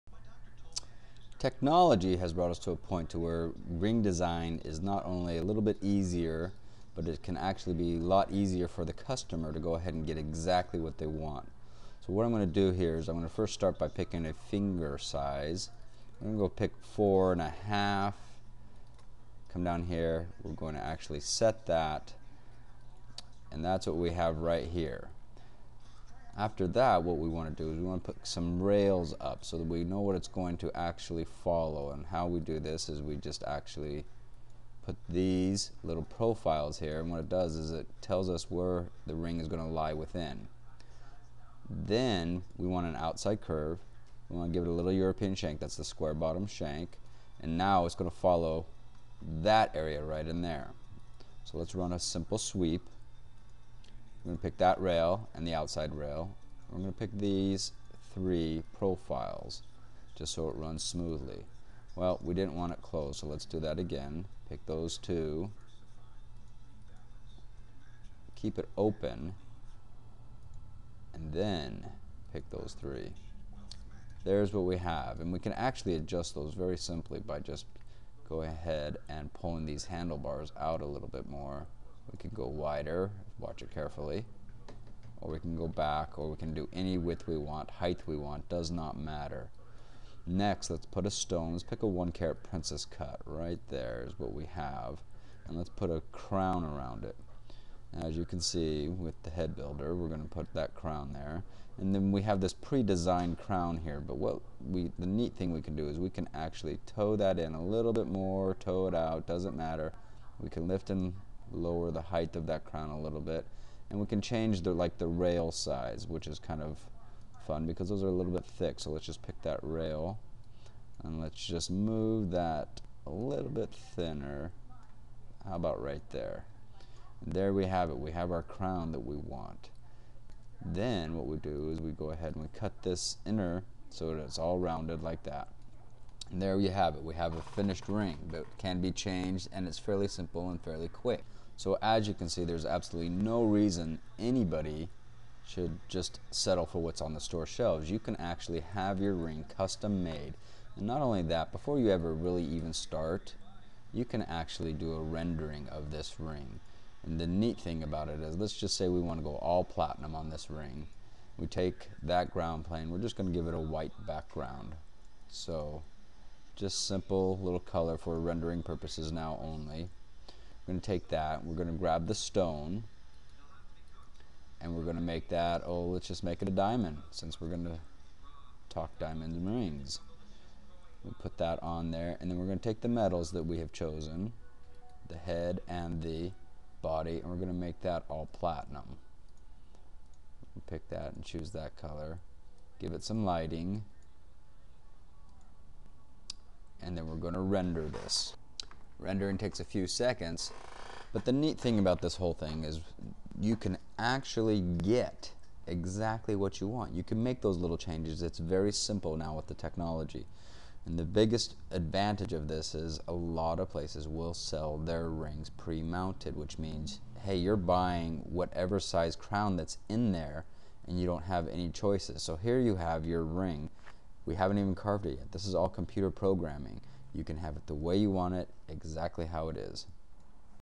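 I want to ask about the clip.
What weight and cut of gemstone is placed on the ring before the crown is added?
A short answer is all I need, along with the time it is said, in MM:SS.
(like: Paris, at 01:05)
1 carat princess cut, at 01:31.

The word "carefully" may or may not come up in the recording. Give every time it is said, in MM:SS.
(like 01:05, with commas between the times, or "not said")
01:23.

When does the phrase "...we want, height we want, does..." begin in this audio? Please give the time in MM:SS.
01:27.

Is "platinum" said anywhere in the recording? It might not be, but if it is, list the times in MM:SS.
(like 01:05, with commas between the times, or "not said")
02:39, 03:08.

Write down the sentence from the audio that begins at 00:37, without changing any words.
And what it does is it tells us where the ring is going to lie within.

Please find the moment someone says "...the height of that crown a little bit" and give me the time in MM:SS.
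01:51.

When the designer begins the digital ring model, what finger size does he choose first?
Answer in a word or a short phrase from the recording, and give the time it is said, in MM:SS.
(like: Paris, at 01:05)
4.5, at 00:16.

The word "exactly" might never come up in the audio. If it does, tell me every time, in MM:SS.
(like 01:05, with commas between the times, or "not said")
00:10, 03:25, 03:48.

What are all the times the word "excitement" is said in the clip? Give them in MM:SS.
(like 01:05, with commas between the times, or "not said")
not said.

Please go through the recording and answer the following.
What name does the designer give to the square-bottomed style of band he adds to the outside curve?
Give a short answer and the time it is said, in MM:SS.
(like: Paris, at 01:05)
European shank, at 00:44.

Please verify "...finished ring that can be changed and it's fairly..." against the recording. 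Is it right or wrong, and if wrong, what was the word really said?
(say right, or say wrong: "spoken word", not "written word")
right.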